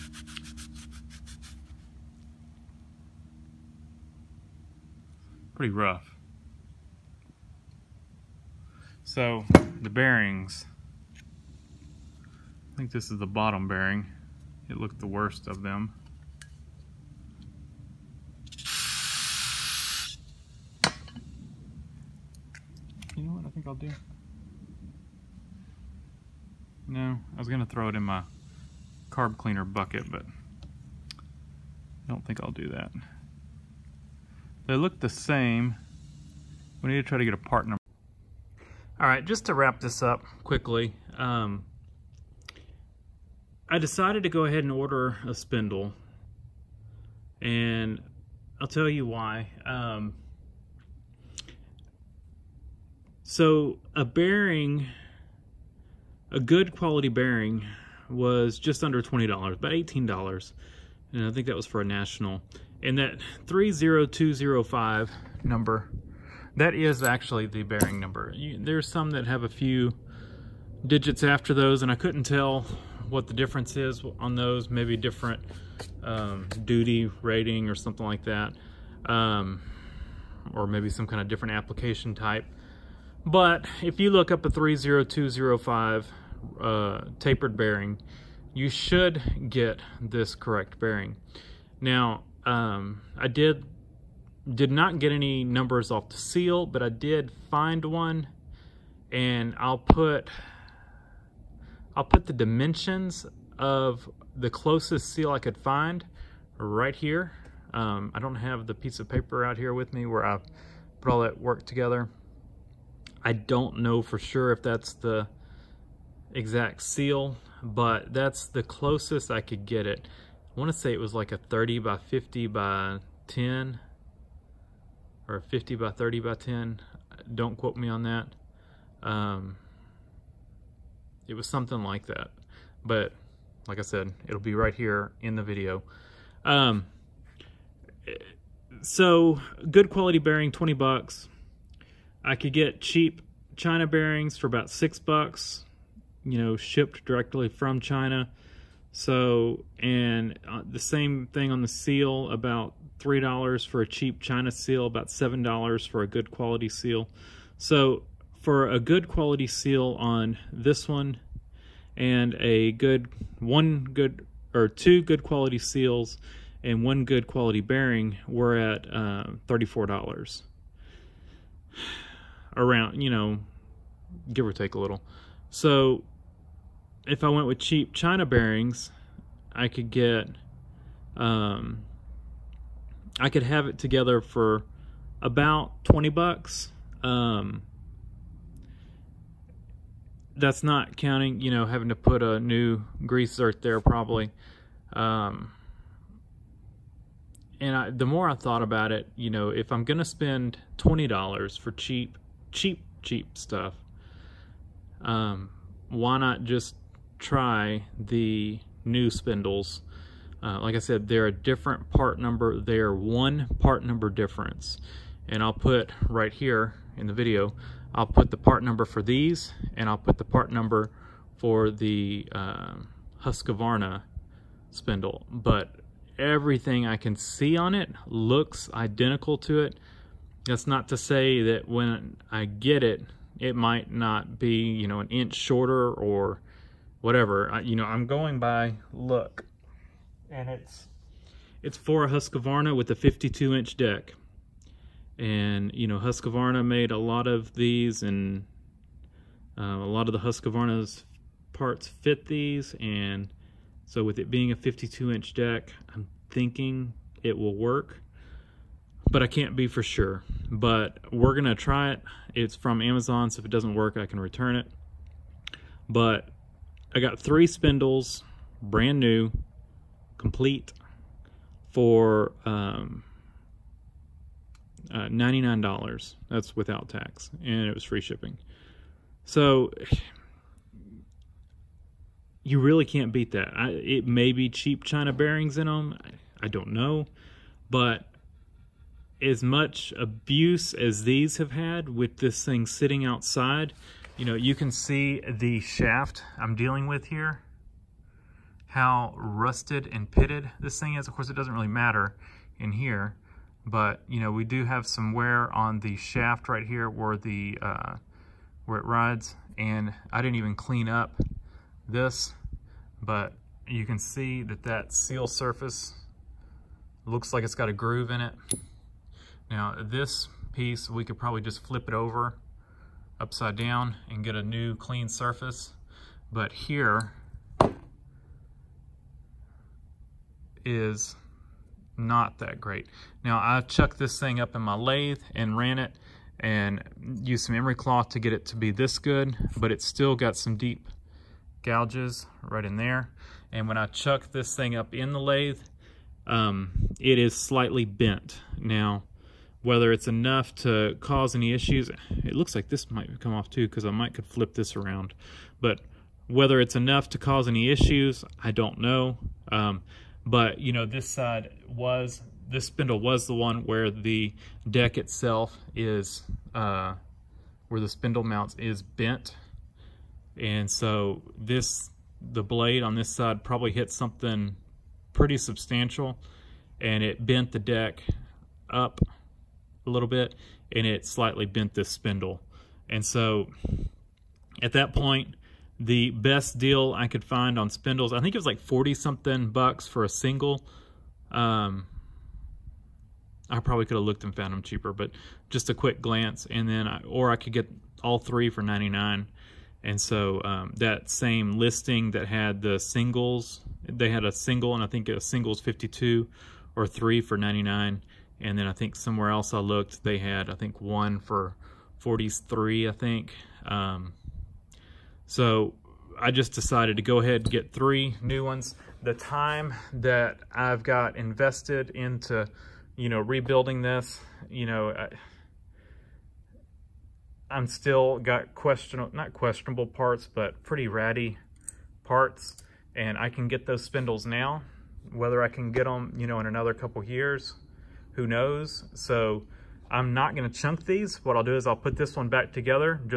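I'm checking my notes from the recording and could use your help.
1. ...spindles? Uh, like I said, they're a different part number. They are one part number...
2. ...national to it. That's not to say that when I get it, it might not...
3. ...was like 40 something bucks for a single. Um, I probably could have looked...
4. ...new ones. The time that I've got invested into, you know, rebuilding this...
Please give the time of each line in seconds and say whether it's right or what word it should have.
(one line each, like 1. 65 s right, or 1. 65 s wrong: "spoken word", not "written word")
1. 209 s right
2. 228 s wrong: "identical", not "national"
3. 388 s right
4. 418 s right.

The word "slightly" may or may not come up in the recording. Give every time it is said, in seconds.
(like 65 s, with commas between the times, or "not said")
347 s, 381 s.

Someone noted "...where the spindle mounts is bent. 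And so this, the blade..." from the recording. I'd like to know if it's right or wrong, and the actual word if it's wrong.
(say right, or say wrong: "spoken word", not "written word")
right.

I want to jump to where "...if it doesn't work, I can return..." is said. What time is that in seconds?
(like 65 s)
263 s.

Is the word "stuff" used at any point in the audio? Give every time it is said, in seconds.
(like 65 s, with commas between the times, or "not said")
203 s.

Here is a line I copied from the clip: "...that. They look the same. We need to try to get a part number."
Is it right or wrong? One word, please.
right.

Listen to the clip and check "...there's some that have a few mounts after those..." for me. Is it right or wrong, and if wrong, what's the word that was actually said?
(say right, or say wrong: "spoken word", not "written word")
wrong: "digits", not "mounts".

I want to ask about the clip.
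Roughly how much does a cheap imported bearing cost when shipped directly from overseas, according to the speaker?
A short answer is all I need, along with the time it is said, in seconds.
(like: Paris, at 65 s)
$6, at 144 s.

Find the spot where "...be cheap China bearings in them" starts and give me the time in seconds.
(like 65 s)
284 s.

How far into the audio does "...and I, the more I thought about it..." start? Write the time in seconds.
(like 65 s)
197 s.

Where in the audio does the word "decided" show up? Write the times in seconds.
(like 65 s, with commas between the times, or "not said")
43 s, 416 s.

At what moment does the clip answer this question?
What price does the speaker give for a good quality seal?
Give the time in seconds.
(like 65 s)
155 s.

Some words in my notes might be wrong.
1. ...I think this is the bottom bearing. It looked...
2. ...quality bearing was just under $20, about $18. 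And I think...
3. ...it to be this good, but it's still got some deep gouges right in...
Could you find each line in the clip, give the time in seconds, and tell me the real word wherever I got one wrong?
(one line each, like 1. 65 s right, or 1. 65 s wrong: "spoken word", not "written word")
1. 12 s right
2. 56 s right
3. 338 s right.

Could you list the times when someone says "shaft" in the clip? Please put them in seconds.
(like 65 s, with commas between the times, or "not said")
295 s, 305 s.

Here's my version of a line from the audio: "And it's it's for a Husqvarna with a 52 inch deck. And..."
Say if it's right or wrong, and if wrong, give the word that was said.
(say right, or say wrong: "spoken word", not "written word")
right.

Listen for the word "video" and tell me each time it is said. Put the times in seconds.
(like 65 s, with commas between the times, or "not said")
135 s, 217 s.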